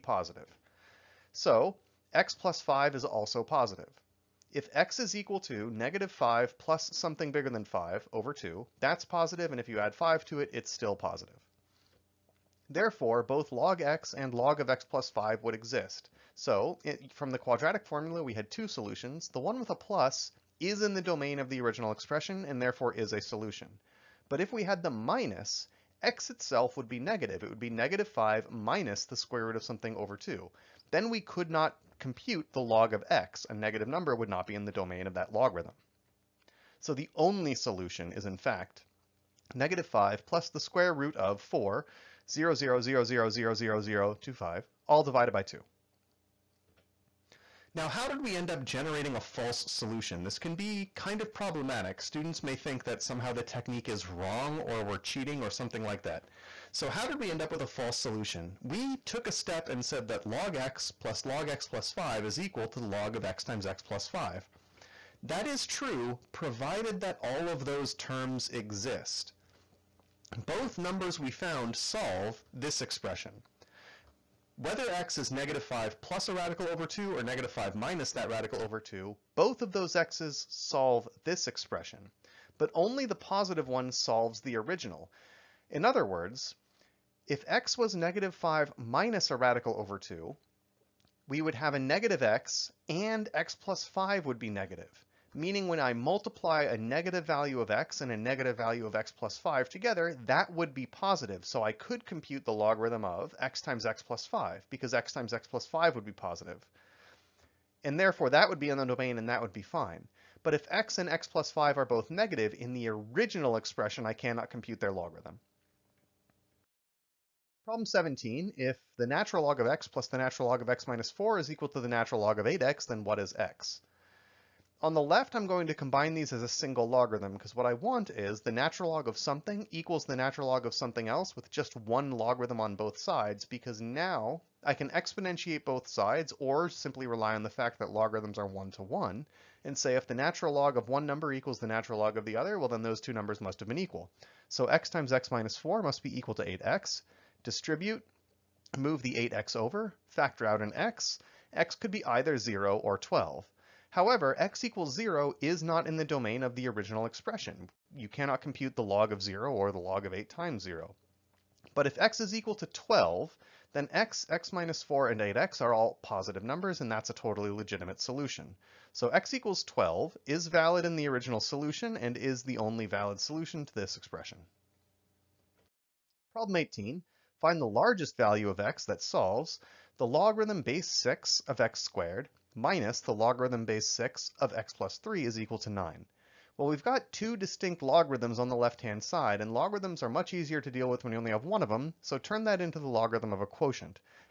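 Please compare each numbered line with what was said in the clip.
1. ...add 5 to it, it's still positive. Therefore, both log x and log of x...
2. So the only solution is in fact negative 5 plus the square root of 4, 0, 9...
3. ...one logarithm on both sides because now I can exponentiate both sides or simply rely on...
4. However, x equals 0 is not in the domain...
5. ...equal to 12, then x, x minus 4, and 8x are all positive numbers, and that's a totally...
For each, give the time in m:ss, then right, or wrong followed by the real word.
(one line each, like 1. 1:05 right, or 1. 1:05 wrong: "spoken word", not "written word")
1. 0:09 right
2. 0:36 wrong: "0", not "9"
3. 2:11 right
4. 2:33 right
5. 2:42 right.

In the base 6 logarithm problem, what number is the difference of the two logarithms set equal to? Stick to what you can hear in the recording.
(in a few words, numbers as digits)
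9.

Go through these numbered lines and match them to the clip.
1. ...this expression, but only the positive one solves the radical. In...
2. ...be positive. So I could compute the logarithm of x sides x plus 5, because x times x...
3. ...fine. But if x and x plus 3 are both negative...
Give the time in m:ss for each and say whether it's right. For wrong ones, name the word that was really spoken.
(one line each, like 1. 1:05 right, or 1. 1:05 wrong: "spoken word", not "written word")
1. 1:21 wrong: "original", not "radical"
2. 1:40 wrong: "times", not "sides"
3. 1:49 wrong: "5", not "3".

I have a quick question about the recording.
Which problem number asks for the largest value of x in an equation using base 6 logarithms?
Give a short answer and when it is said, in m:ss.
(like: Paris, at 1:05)
18, at 2:56.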